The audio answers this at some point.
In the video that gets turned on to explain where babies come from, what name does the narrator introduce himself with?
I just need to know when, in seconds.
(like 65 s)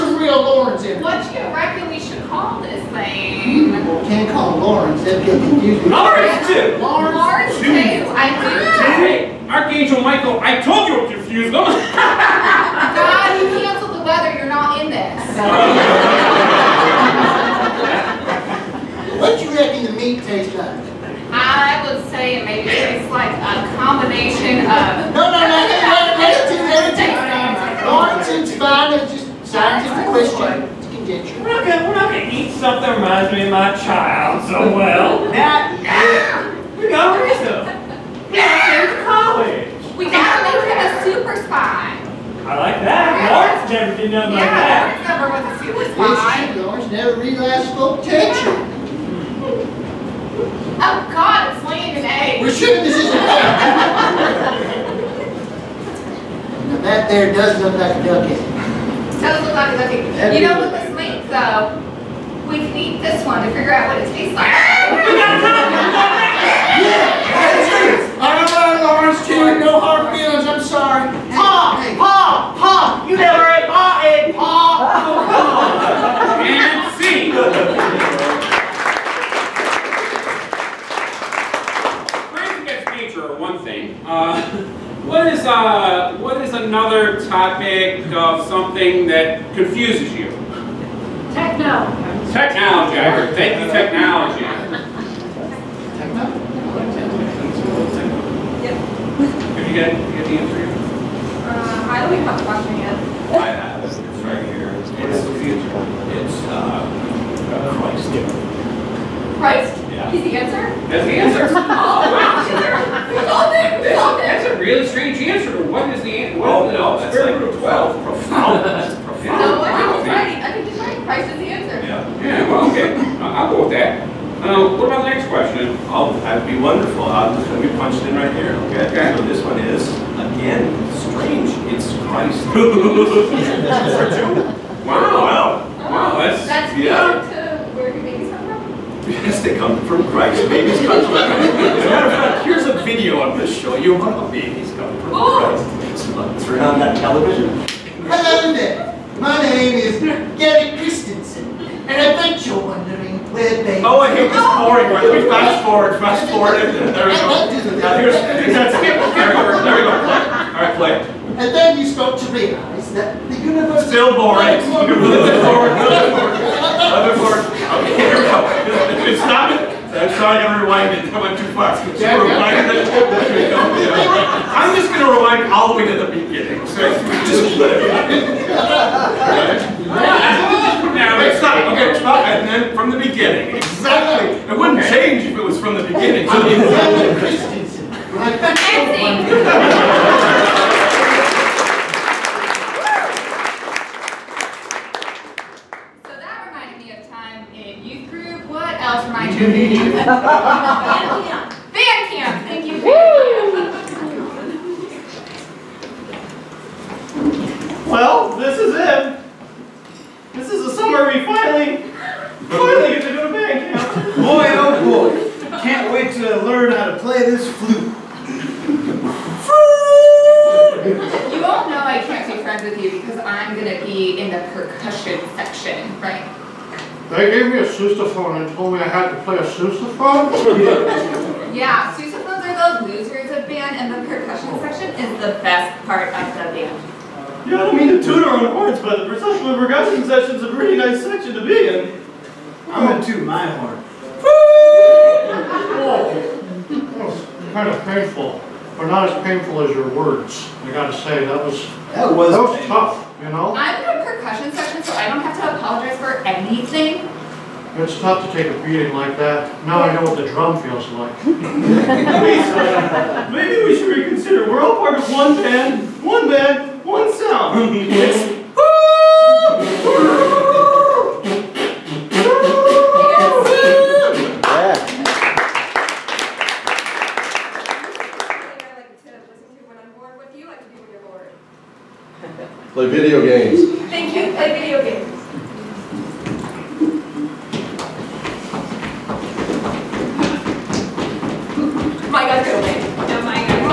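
150 s.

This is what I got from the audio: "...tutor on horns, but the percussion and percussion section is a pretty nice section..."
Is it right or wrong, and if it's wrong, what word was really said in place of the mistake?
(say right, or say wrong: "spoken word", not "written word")
right.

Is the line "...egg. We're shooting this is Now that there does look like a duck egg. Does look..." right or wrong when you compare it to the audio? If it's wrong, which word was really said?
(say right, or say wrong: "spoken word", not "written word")
right.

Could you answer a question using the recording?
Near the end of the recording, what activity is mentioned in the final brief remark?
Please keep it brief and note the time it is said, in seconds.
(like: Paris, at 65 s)
Play video games, at 282 s.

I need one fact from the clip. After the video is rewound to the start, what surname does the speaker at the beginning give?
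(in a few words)
Christensen.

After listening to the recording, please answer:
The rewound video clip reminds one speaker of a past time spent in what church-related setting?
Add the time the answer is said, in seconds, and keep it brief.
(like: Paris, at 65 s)
Youth group, at 197 s.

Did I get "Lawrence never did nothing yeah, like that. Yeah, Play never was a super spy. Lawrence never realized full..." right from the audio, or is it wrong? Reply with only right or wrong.
wrong.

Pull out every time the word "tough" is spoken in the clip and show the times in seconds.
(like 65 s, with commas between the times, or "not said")
252 s, 258 s.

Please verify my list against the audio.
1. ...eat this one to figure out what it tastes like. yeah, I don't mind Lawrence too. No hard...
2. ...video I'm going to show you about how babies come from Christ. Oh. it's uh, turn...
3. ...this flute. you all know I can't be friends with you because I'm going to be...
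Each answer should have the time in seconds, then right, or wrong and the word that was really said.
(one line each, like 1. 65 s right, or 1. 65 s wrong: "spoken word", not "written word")
1. 62 s right
2. 142 s right
3. 217 s right.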